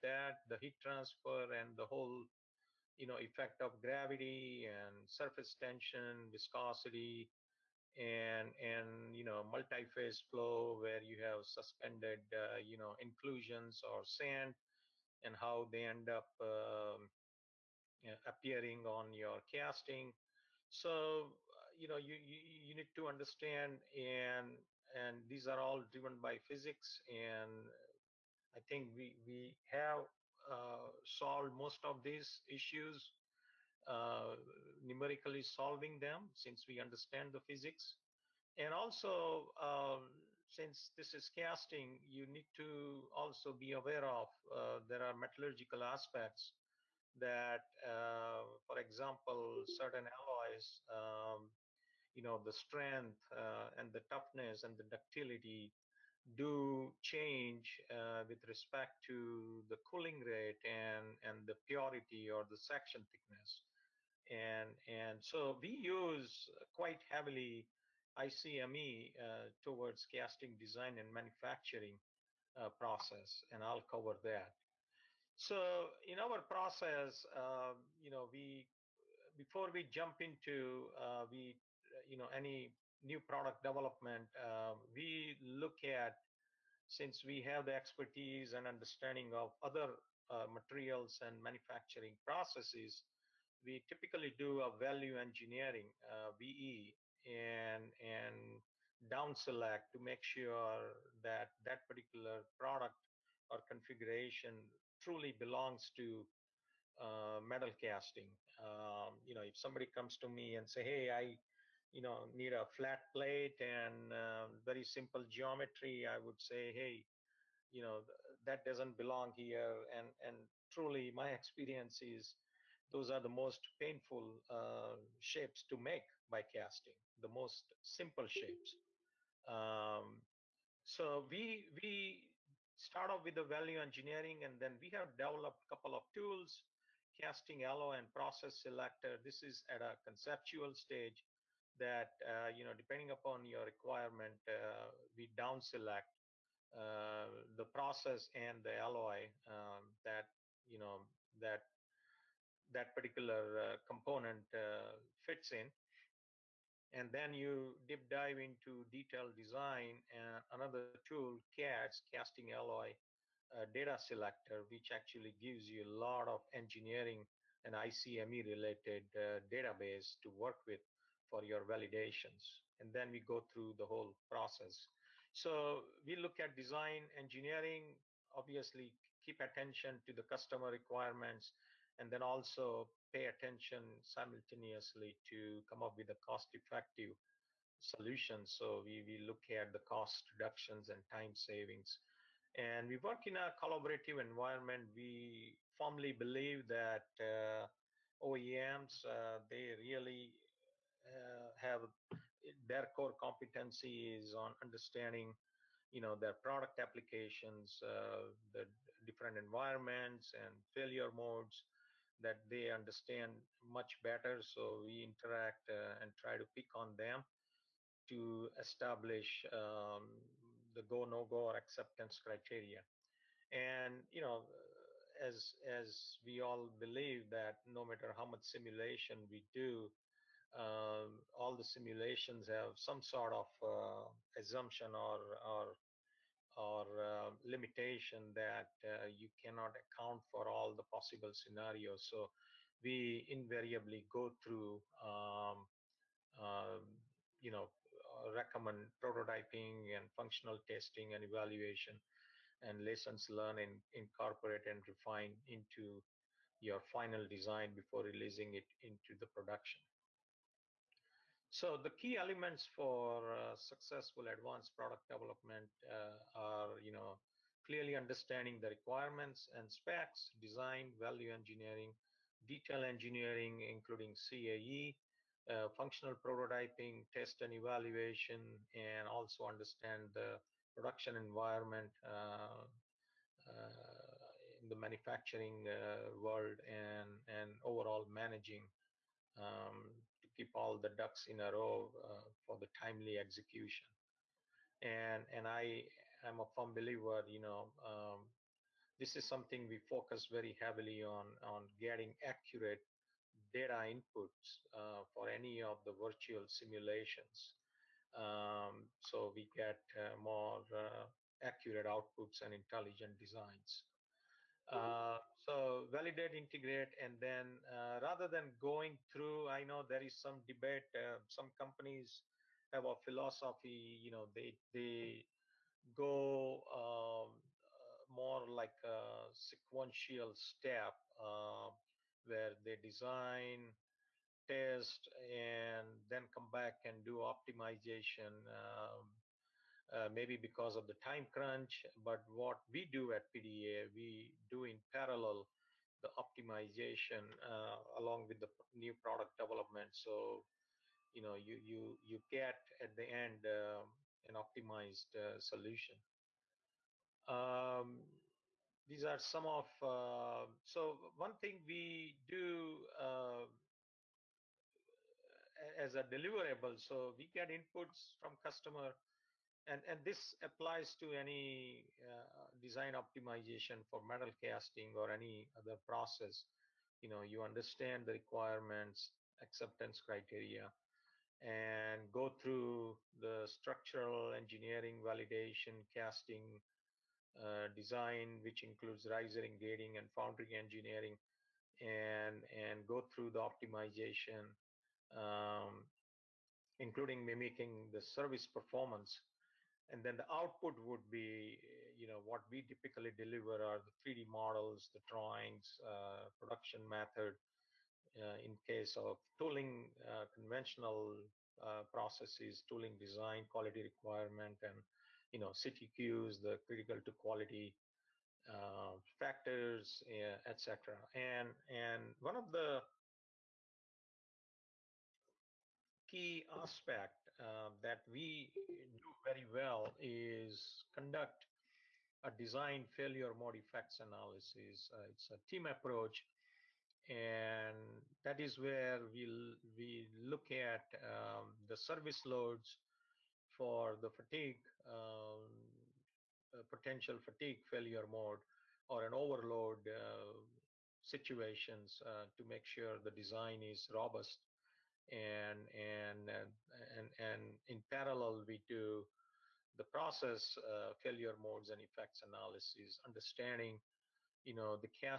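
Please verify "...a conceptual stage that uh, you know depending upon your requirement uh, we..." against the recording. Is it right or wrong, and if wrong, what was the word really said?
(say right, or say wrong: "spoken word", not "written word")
right.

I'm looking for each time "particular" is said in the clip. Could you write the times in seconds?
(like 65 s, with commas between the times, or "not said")
101 s, 152 s.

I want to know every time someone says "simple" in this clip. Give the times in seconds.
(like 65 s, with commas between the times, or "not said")
114 s, 127 s.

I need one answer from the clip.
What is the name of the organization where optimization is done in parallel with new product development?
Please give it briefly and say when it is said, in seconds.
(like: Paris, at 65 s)
PDA, at 343 s.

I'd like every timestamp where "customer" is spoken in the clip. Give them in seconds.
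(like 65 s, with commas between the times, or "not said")
180 s, 368 s.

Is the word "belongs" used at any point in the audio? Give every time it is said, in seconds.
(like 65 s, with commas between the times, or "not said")
105 s, 118 s.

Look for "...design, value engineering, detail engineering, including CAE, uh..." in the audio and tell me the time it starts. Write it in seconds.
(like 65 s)
270 s.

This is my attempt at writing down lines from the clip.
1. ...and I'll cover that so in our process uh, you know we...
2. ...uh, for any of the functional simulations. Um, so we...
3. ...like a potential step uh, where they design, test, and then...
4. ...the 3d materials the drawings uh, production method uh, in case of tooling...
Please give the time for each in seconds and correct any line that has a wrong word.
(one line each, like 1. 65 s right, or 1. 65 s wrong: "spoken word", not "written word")
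1. 73 s right
2. 304 s wrong: "virtual", not "functional"
3. 328 s wrong: "sequential", not "potential"
4. 403 s wrong: "models", not "materials".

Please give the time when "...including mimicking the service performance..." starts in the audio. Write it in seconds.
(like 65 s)
396 s.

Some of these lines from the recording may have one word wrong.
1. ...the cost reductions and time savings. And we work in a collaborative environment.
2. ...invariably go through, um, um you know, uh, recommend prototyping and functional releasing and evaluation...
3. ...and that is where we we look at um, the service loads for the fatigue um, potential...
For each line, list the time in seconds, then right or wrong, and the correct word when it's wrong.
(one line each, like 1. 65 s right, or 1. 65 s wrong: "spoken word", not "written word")
1. 189 s right
2. 243 s wrong: "testing", not "releasing"
3. 437 s right.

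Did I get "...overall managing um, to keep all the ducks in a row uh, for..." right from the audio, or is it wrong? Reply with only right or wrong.
right.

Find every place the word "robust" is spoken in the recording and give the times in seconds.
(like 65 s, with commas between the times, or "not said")
453 s.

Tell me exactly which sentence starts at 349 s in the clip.
So, you know, you you you get at the end uh, an optimized uh, solution.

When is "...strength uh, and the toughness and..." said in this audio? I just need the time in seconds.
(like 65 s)
52 s.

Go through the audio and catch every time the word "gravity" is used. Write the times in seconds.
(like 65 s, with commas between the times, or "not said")
3 s.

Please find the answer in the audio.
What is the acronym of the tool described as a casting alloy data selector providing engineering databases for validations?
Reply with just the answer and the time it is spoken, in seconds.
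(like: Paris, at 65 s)
CATS, at 161 s.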